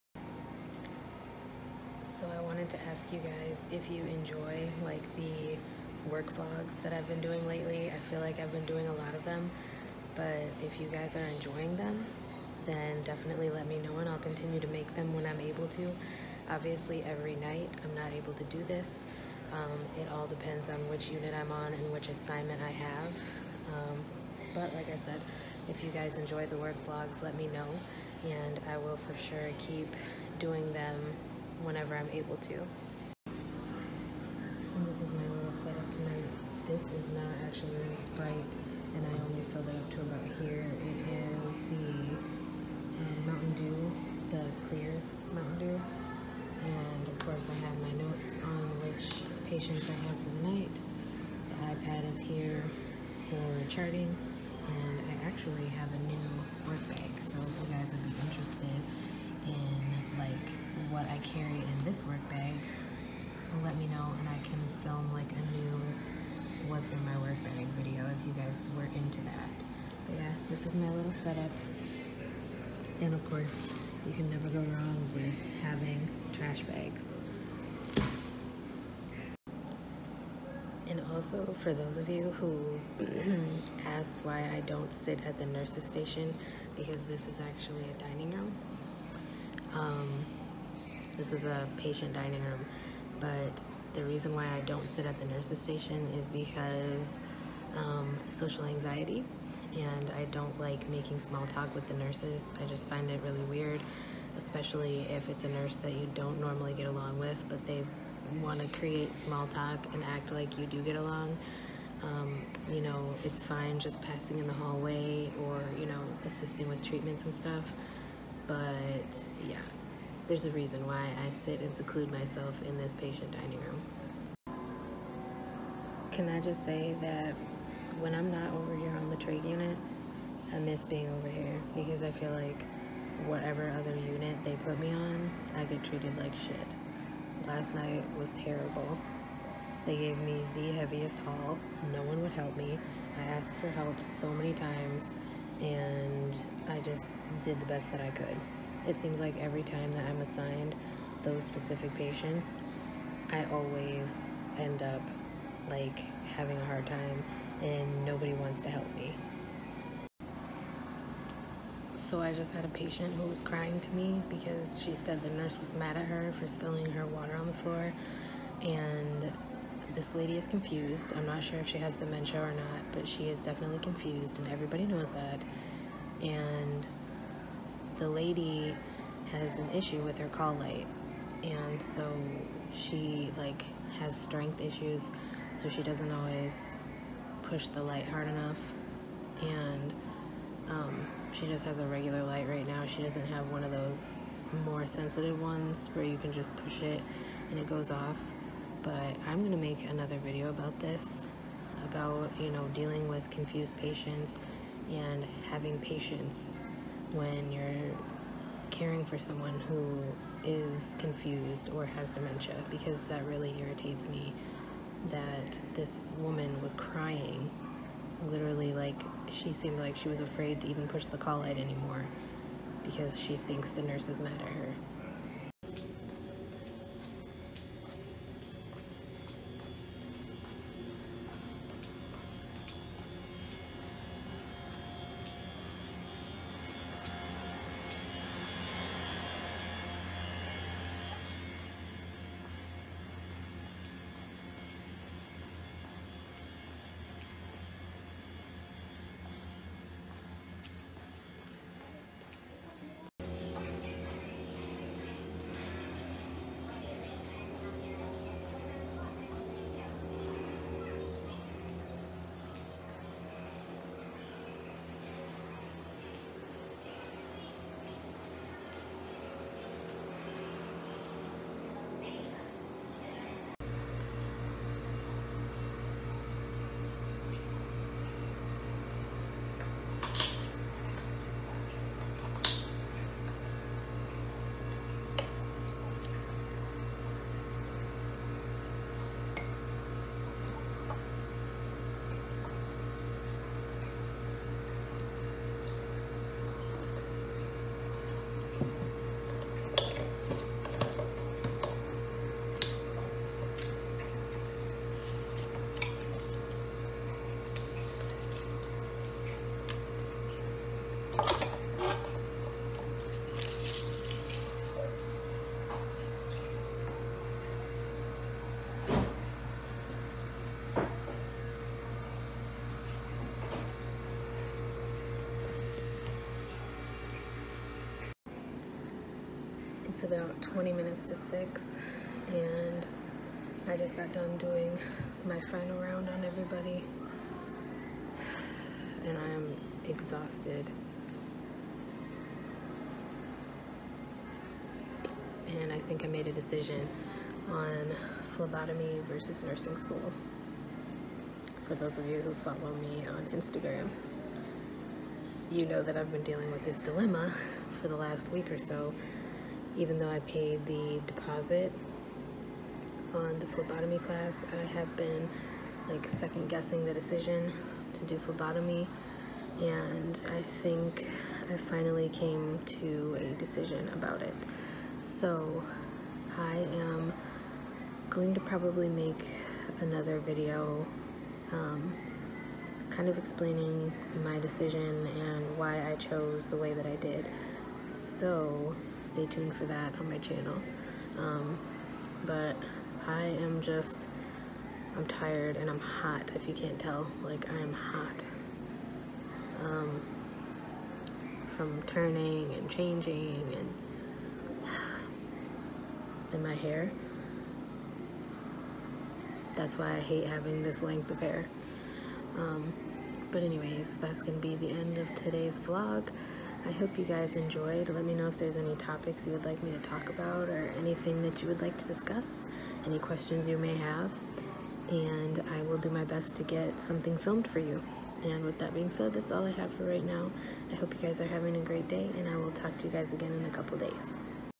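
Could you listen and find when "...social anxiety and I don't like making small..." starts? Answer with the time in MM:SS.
01:38.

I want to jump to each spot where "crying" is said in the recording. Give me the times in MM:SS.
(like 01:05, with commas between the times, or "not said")
02:43, 03:36.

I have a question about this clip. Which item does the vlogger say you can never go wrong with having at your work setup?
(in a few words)
trash bags.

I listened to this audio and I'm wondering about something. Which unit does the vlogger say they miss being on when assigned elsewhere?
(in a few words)
trade unit.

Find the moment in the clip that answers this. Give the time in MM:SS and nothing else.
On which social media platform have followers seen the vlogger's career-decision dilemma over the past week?
05:53.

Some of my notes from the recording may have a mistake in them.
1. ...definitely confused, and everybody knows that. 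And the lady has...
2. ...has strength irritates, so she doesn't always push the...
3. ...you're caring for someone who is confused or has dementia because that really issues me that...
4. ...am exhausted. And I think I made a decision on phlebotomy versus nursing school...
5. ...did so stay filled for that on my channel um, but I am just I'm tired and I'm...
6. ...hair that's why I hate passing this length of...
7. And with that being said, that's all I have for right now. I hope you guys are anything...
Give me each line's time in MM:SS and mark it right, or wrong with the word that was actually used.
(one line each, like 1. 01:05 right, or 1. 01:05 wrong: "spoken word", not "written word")
1. 02:53 right
2. 03:03 wrong: "issues", not "irritates"
3. 03:27 wrong: "irritates", not "issues"
4. 05:39 right
5. 06:26 wrong: "tuned", not "filled"
6. 06:46 wrong: "having", not "passing"
7. 07:08 wrong: "having", not "anything".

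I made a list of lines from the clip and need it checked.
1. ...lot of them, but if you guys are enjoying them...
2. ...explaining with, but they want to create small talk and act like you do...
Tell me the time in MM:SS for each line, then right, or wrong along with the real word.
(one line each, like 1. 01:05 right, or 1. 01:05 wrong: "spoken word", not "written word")
1. 00:08 right
2. 01:46 wrong: "along", not "explaining".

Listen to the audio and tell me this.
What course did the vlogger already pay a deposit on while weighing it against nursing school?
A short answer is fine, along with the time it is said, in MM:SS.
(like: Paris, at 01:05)
phlebotomy class, at 06:03.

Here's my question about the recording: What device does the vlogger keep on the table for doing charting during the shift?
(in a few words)
iPad.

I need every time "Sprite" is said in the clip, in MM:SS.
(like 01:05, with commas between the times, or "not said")
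00:37.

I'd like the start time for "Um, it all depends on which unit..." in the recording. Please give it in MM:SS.
00:19.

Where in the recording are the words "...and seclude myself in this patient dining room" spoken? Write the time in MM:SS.
02:01.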